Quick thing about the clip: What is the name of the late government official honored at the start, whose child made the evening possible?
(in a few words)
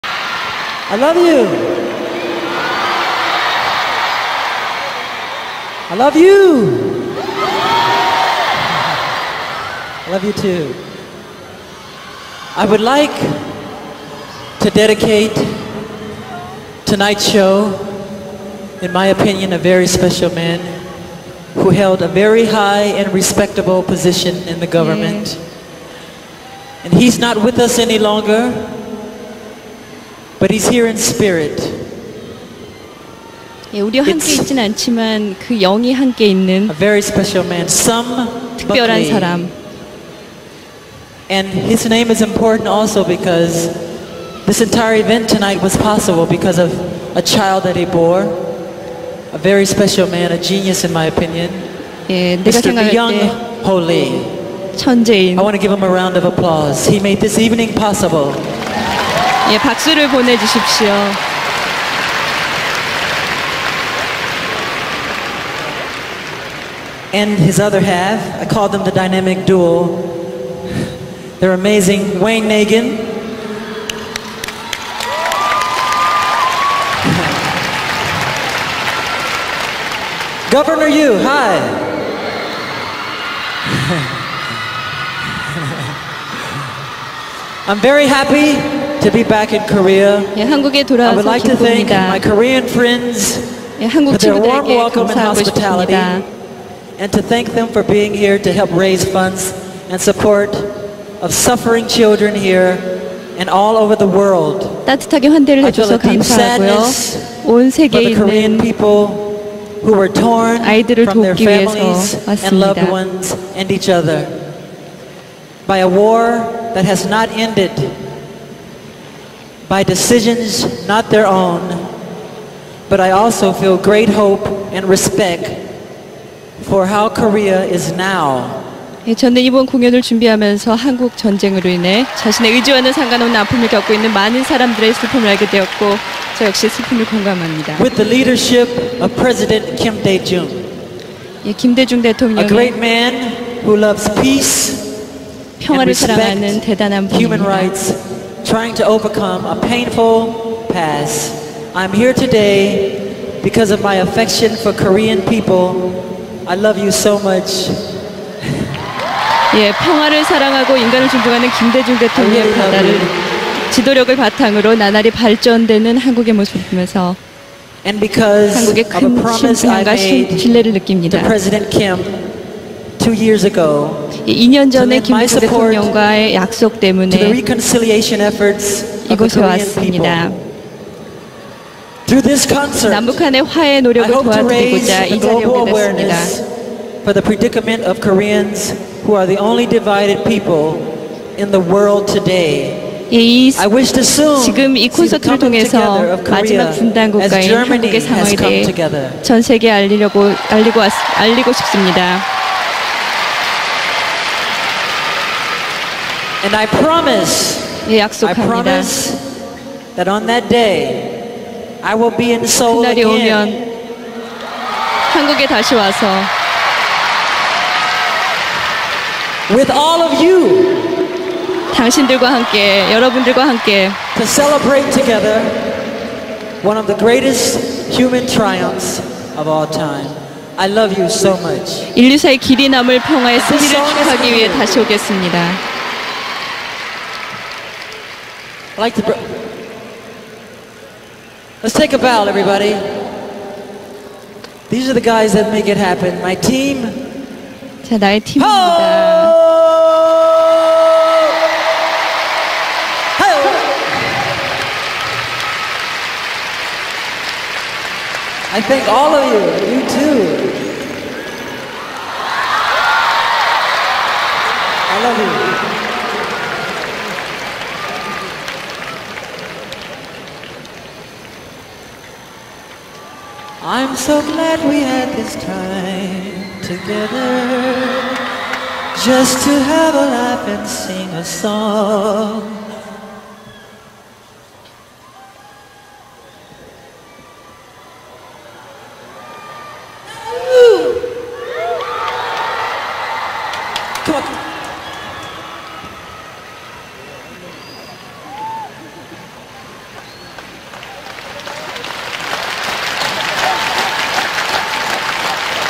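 Young Holy.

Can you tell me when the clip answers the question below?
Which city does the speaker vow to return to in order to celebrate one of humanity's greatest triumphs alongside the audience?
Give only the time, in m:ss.
3:32.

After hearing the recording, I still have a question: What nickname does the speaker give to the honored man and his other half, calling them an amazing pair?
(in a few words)
the dynamic duo.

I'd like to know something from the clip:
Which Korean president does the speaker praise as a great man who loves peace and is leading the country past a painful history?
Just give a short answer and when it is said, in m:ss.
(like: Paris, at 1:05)
Kim Dae-jung, at 2:19.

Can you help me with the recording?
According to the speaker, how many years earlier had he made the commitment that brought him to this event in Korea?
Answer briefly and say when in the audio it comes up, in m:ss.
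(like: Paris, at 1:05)
2, at 2:53.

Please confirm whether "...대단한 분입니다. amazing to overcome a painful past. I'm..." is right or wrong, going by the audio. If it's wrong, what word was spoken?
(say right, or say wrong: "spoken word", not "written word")
wrong: "trying", not "amazing".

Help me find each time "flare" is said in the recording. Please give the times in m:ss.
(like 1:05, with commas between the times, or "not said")
not said.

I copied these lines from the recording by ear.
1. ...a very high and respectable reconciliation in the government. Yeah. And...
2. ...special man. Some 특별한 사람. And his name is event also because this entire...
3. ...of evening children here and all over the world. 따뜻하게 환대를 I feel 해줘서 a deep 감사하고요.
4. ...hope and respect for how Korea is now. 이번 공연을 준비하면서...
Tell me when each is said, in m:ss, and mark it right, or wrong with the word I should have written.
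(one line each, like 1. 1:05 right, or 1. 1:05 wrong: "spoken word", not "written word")
1. 0:22 wrong: "position", not "reconciliation"
2. 0:36 wrong: "important", not "event"
3. 1:41 wrong: "suffering", not "evening"
4. 2:04 right.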